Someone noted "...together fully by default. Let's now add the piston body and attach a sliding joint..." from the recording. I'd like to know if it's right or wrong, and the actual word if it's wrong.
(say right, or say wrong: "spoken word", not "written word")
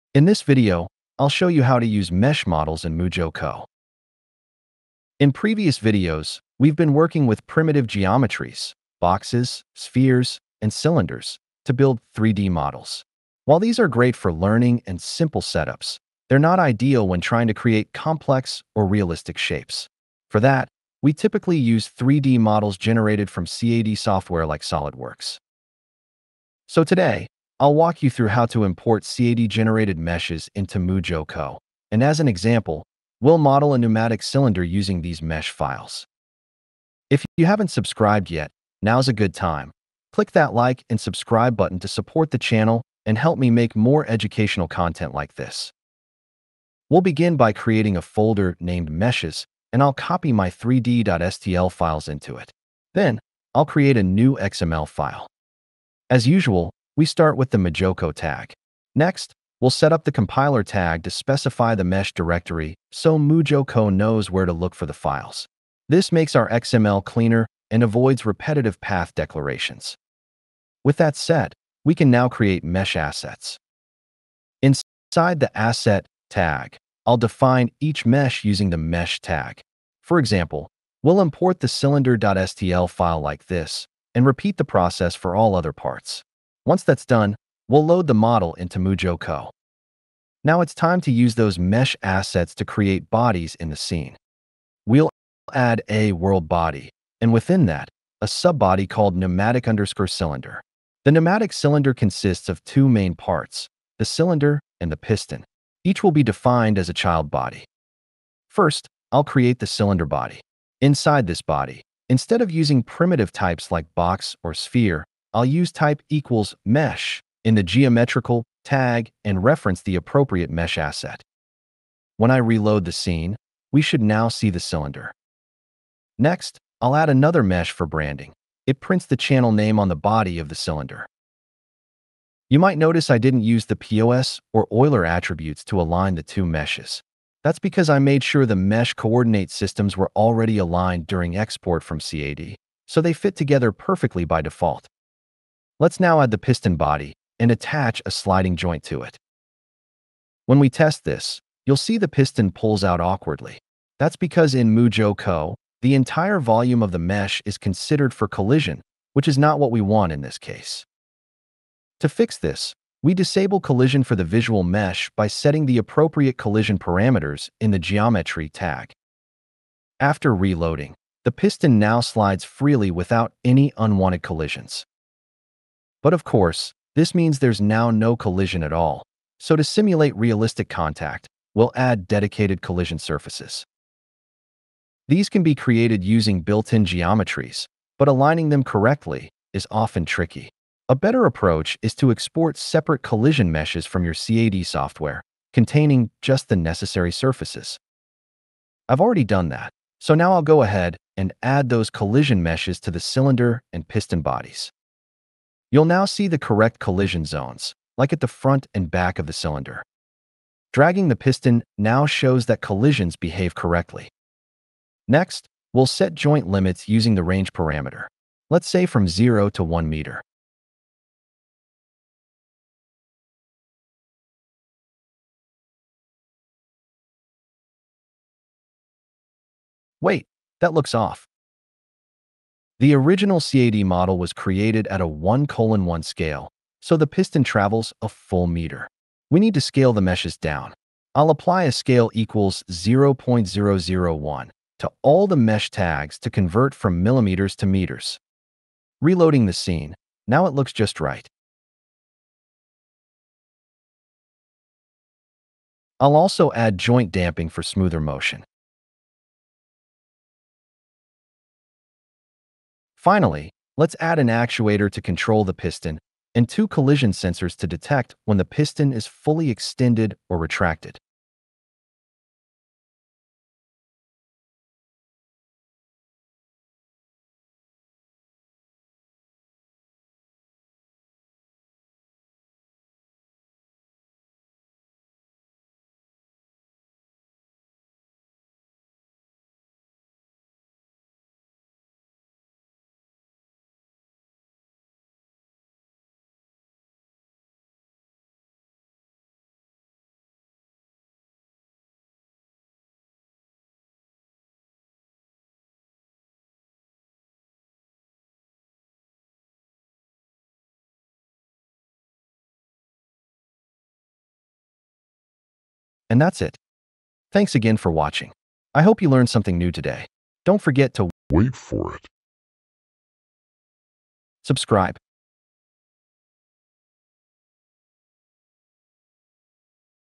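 wrong: "perfectly", not "fully".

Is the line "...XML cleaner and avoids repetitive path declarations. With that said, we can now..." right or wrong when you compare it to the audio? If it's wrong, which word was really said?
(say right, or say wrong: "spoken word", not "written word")
right.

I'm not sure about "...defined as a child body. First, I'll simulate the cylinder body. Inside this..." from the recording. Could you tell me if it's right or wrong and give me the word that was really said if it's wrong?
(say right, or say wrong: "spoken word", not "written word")
wrong: "create", not "simulate".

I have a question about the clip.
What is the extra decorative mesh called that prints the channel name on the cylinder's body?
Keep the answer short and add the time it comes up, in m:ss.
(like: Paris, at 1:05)
branding, at 2:07.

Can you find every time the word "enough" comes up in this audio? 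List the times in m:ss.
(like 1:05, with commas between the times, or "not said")
not said.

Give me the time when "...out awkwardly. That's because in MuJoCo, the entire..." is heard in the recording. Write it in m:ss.
2:32.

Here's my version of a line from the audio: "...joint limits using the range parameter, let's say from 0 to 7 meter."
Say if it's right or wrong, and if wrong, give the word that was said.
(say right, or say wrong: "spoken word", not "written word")
wrong: "1", not "7".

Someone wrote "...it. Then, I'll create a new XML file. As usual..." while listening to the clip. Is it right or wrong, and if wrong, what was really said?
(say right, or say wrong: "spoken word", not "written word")
right.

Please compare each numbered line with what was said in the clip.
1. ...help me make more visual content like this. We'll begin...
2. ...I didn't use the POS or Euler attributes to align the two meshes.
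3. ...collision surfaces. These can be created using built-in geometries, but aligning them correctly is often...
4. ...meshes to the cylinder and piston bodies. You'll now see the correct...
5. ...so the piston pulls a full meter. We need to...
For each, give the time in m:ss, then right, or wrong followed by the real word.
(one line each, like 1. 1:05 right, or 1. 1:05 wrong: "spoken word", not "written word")
1. 0:43 wrong: "educational", not "visual"
2. 2:13 right
3. 3:02 right
4. 3:22 right
5. 3:56 wrong: "travels", not "pulls".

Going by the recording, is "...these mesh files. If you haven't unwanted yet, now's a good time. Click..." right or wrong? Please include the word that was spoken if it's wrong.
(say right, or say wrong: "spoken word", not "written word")
wrong: "subscribed", not "unwanted".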